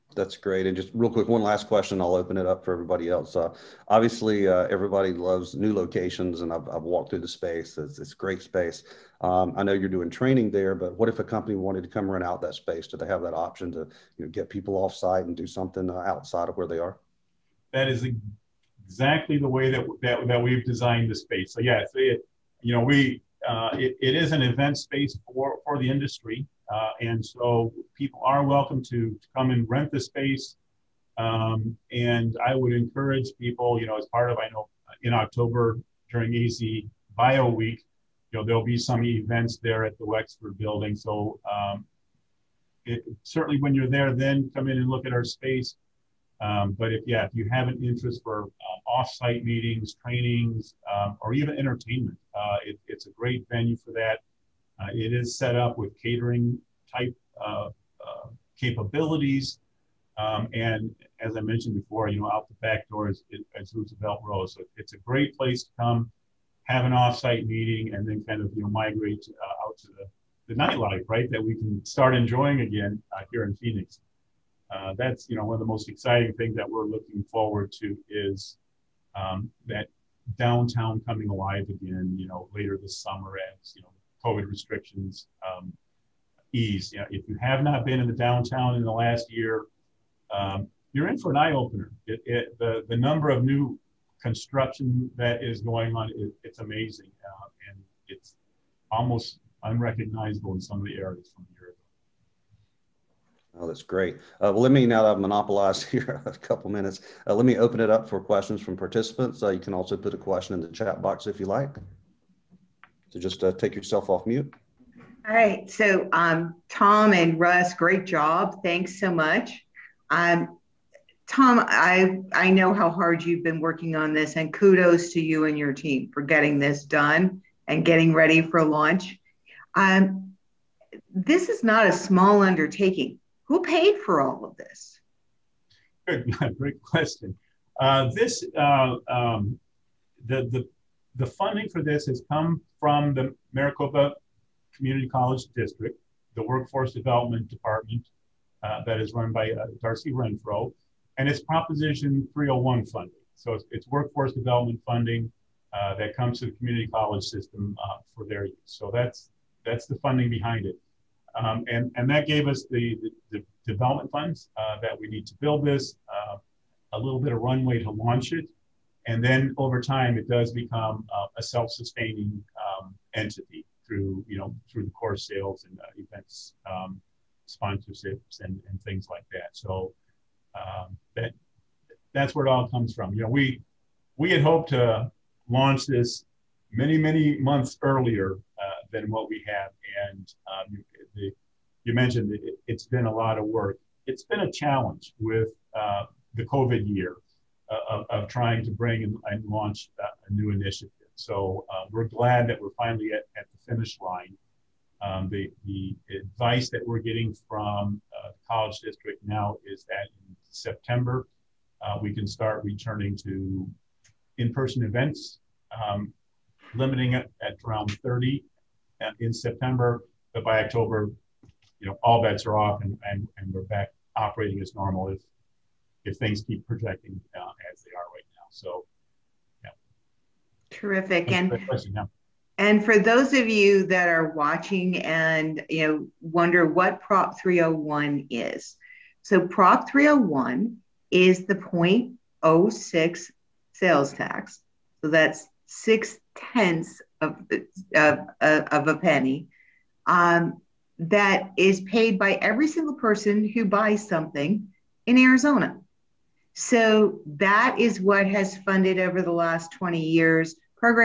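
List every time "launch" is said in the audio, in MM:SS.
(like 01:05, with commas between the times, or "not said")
02:08, 02:47, 03:05, 03:19.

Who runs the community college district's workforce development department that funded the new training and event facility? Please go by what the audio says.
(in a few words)
Darcy Renfro.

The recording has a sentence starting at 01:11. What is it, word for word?
That we can start enjoying again uh, here in Phoenix.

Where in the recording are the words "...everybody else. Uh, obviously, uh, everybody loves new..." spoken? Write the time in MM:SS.
00:02.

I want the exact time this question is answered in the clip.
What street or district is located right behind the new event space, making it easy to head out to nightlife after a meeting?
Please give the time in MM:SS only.
01:03.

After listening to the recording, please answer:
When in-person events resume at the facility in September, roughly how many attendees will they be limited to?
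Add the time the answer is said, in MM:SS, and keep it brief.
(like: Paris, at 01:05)
30, at 03:38.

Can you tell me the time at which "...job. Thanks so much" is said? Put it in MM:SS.
01:58.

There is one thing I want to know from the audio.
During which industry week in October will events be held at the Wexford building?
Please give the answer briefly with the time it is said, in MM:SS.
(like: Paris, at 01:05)
AZ Bio Week, at 00:36.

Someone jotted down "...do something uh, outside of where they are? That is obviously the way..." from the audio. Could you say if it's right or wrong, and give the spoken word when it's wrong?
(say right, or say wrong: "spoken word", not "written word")
wrong: "exactly", not "obviously".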